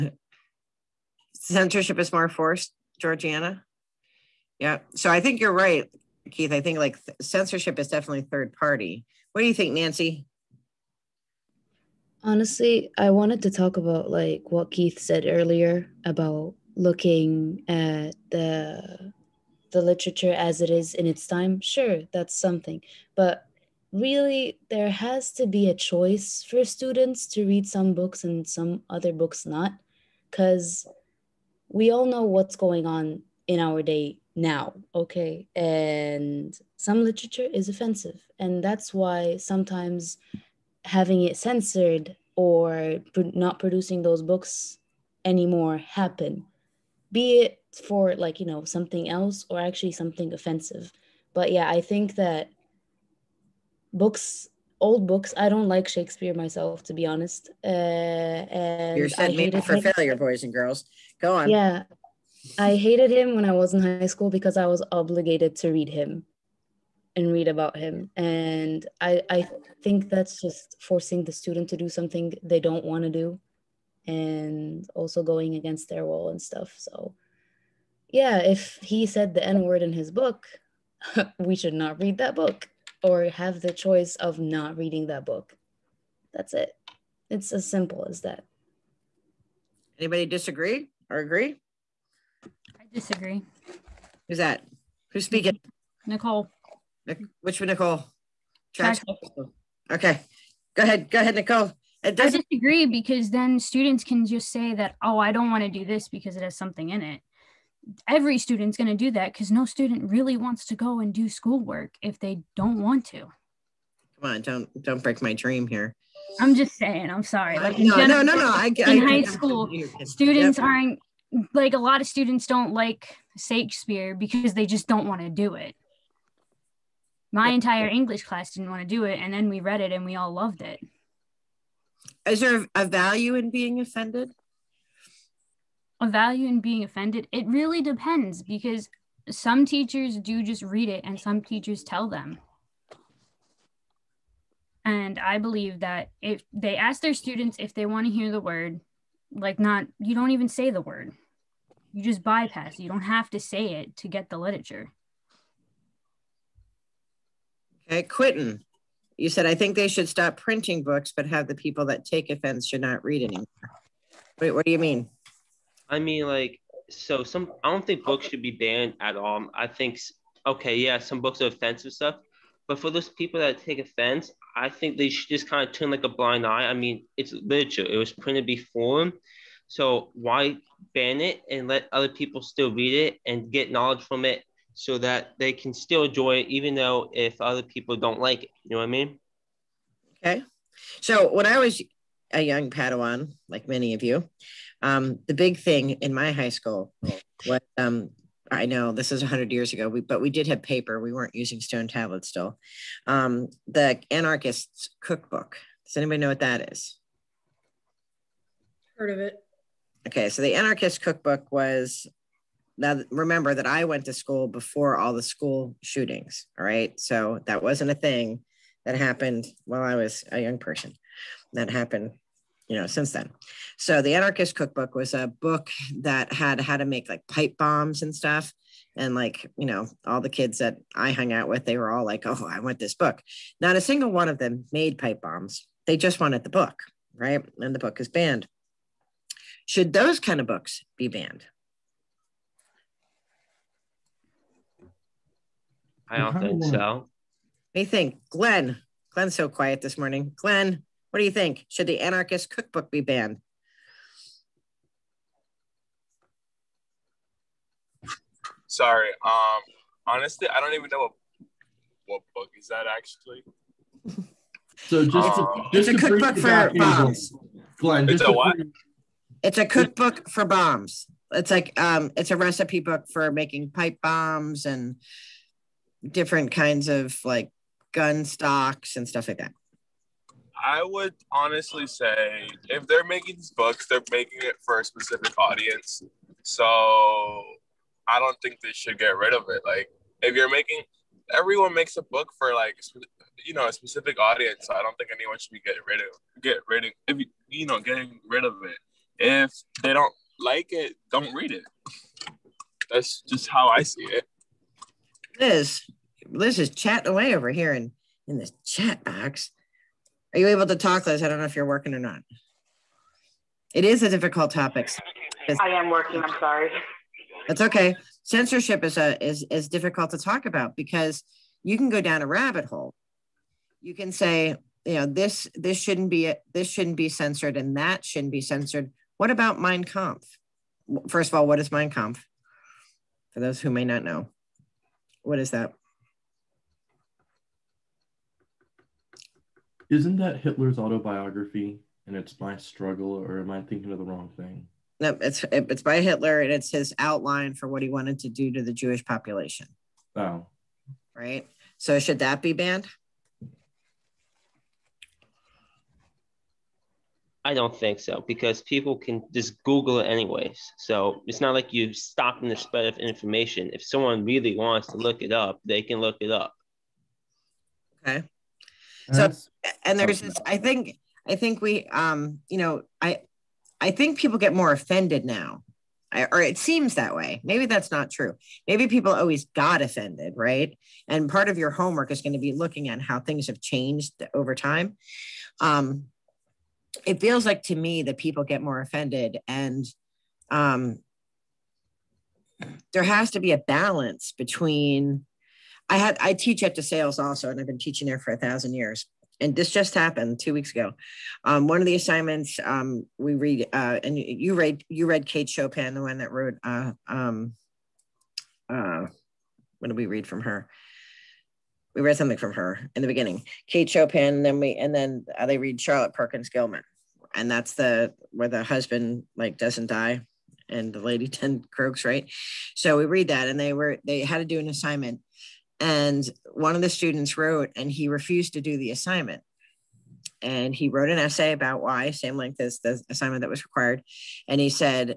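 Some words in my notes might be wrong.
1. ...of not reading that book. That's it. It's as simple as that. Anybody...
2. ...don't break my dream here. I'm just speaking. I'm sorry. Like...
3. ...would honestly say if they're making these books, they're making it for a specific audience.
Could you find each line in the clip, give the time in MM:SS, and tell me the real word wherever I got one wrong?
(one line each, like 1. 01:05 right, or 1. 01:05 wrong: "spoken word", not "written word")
1. 01:24 right
2. 01:54 wrong: "saying", not "speaking"
3. 04:40 right.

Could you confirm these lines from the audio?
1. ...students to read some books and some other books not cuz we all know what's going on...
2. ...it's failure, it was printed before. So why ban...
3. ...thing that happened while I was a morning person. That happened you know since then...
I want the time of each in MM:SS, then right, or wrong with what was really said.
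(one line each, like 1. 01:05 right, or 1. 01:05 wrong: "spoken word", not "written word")
1. 00:26 right
2. 02:57 wrong: "literature", not "failure"
3. 03:37 wrong: "young", not "morning".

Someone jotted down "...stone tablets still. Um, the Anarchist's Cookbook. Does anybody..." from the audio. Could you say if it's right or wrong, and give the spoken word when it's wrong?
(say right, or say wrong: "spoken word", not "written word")
right.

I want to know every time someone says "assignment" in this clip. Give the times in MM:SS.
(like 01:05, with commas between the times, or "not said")
06:41, 07:04, 07:08, 07:13.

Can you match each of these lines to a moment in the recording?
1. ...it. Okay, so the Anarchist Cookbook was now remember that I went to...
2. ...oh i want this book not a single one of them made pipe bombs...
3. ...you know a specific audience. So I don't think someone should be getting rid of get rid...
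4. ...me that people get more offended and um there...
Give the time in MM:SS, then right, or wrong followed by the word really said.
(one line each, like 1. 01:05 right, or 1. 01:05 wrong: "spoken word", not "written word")
1. 03:29 right
2. 03:52 right
3. 04:53 wrong: "anyone", not "someone"
4. 06:27 right.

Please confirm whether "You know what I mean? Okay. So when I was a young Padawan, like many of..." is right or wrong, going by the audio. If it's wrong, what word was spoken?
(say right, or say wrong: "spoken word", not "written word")
right.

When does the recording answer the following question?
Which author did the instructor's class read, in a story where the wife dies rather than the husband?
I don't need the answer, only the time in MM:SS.
06:55.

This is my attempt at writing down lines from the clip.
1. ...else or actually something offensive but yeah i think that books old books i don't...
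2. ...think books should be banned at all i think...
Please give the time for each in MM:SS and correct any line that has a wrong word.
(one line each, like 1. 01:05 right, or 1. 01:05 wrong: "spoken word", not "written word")
1. 00:49 right
2. 02:47 right.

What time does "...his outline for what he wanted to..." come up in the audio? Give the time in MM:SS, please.
05:46.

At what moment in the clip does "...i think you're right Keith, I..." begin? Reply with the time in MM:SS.
00:05.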